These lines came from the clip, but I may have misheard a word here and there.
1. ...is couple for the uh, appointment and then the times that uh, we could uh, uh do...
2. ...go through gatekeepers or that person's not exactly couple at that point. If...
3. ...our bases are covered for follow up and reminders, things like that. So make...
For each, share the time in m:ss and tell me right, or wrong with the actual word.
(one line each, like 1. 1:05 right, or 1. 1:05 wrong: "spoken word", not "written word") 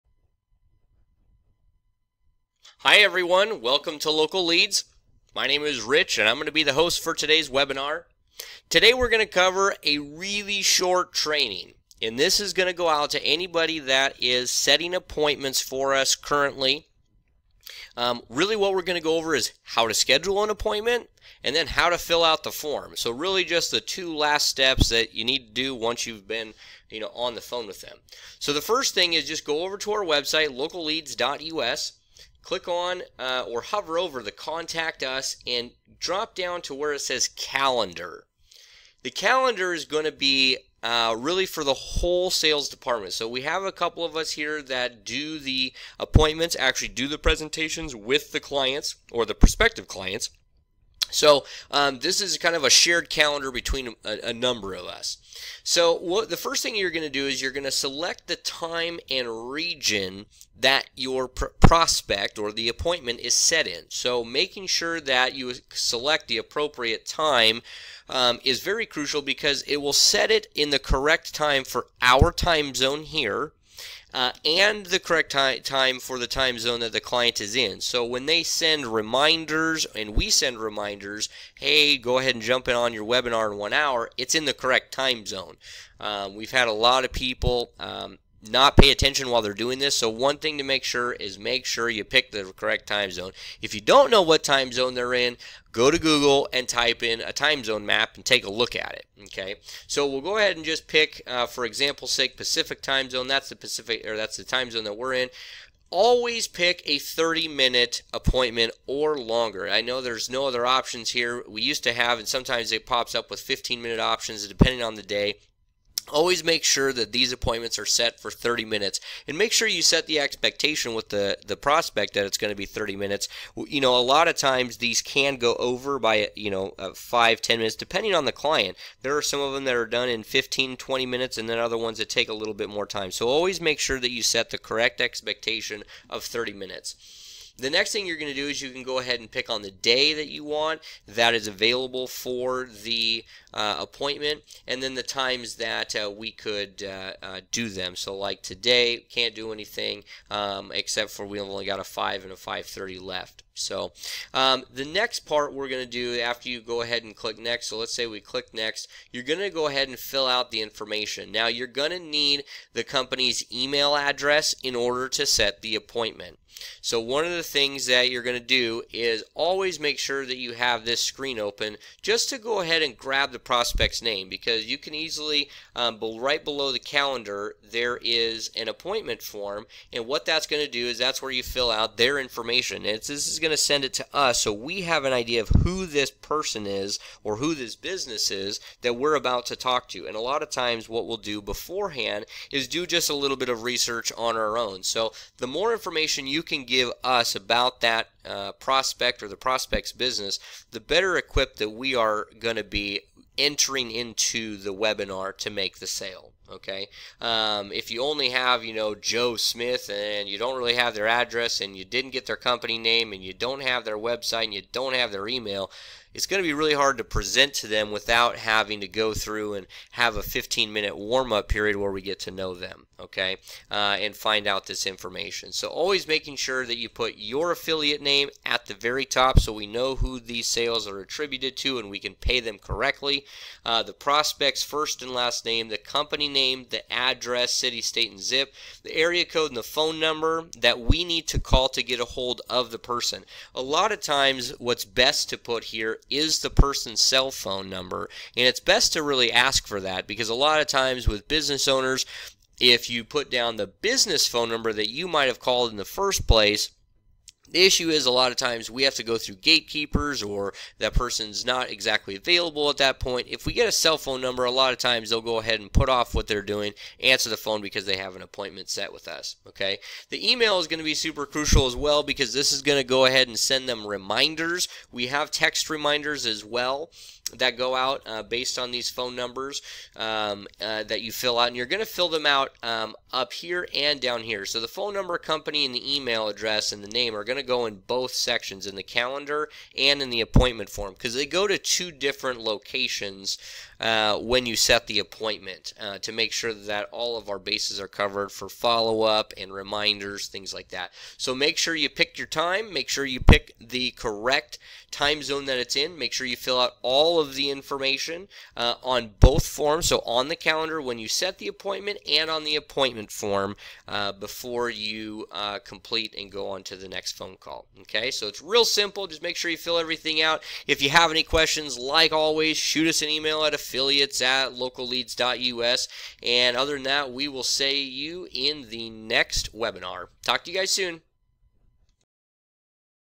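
1. 2:21 wrong: "available", not "couple"
2. 4:19 wrong: "available", not "couple"
3. 4:57 right.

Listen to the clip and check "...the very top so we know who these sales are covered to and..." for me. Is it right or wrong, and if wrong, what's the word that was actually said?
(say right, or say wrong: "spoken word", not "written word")
wrong: "attributed", not "covered".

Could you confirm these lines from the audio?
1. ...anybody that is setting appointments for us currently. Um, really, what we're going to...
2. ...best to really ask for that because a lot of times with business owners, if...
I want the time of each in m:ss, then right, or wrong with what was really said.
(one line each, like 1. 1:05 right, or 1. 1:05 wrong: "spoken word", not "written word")
1. 0:13 right
2. 4:08 right.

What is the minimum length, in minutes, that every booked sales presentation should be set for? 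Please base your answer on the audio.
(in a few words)
30.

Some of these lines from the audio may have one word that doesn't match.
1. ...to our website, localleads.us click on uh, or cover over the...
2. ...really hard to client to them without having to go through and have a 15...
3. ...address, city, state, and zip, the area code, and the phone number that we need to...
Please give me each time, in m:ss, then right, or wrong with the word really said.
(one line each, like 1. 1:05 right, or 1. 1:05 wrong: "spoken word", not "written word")
1. 0:29 wrong: "hover", not "cover"
2. 3:36 wrong: "present", not "client"
3. 3:56 right.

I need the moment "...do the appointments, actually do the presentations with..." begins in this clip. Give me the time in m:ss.
0:45.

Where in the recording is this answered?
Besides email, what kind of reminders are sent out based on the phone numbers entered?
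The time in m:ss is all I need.
4:35.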